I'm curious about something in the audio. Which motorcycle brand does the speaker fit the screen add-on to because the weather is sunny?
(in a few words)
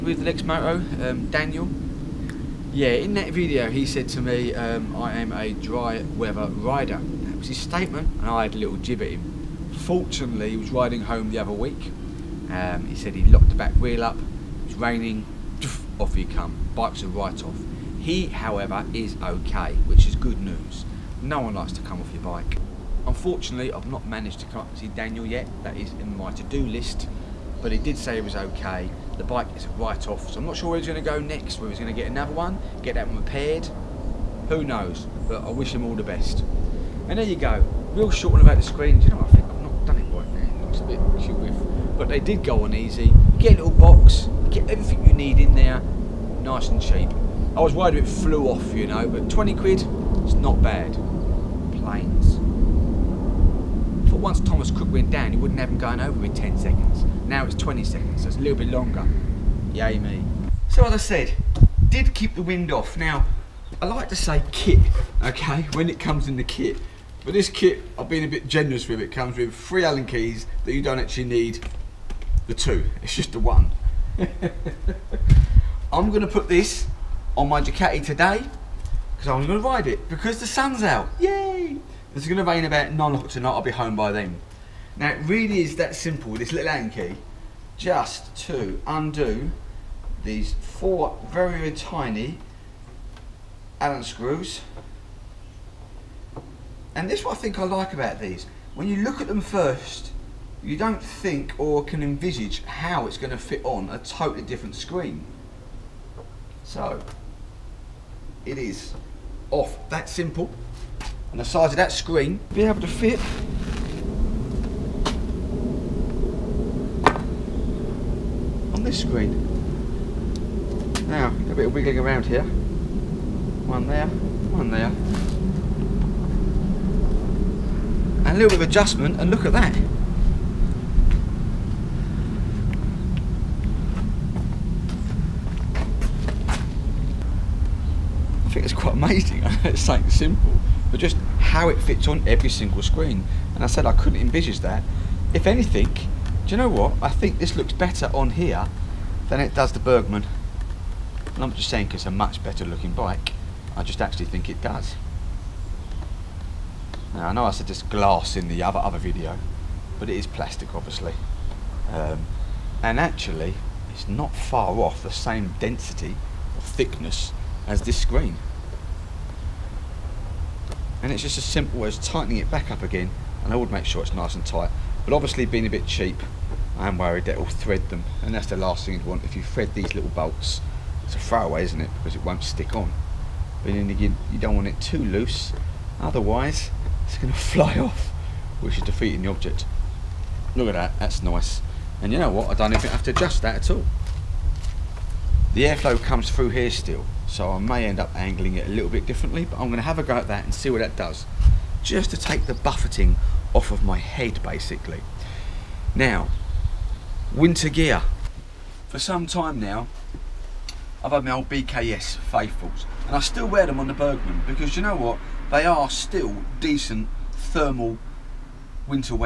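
Ducati.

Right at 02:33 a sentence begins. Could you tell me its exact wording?
I just actually think it does.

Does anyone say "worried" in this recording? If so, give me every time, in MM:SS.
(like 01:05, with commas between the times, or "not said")
00:47, 02:56.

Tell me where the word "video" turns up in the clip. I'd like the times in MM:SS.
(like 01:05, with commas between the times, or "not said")
00:03, 02:38.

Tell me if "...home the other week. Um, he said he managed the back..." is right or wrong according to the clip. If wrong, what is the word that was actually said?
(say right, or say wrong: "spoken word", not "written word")
wrong: "locked", not "managed".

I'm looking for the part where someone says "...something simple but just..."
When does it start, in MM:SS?
02:19.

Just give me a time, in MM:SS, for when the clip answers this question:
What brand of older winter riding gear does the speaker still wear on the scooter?
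03:31.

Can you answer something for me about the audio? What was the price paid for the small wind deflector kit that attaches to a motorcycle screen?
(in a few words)
20 quid.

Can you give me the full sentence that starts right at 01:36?
And this is what I think I like about these.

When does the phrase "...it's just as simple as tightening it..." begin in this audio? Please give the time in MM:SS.
02:51.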